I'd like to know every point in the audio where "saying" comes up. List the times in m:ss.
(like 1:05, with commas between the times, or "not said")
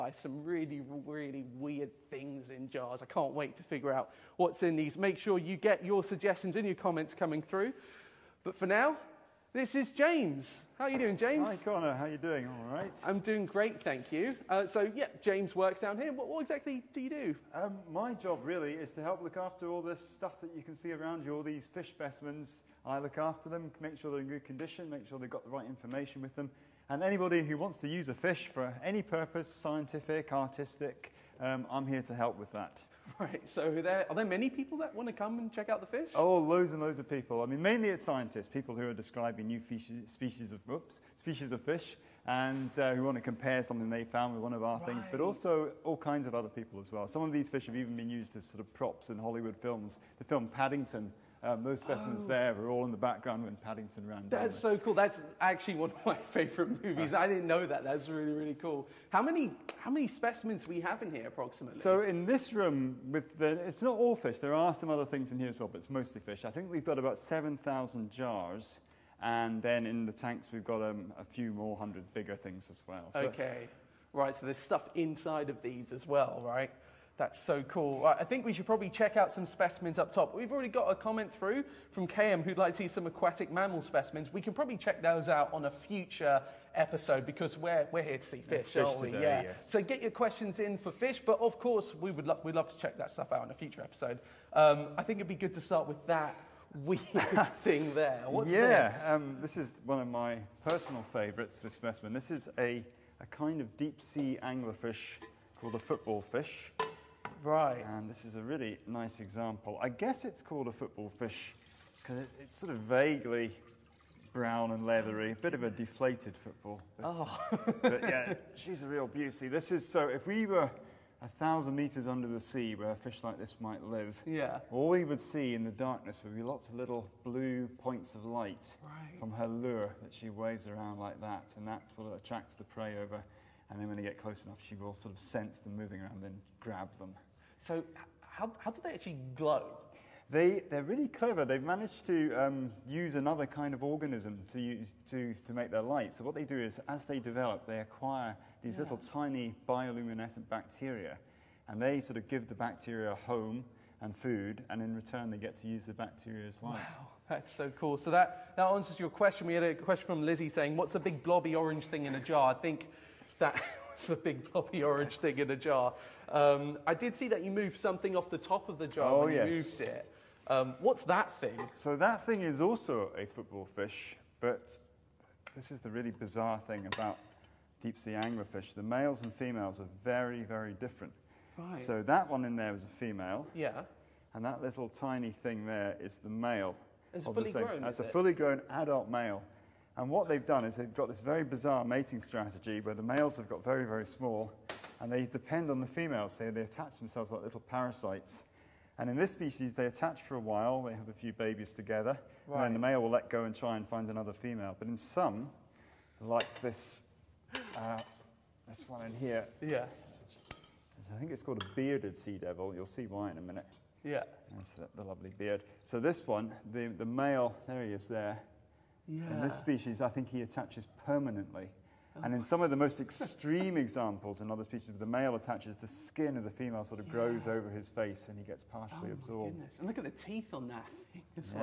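2:40.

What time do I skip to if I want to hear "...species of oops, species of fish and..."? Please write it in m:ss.
0:40.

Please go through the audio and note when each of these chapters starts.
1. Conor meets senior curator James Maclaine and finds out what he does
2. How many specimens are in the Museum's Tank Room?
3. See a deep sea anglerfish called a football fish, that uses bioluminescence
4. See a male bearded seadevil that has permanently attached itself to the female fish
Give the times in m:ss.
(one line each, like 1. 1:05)
1. 0:07
2. 0:58
3. 1:34
4. 3:18.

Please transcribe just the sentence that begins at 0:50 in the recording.
The film Paddington um, those specimens oh.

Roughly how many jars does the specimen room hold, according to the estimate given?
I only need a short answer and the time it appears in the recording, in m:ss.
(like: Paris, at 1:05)
7000, at 1:07.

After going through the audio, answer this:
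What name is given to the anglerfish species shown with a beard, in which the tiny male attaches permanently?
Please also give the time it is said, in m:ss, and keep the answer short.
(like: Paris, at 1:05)
bearded sea devil, at 3:31.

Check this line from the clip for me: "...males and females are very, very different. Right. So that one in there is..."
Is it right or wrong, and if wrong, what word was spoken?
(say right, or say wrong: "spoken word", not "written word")
right.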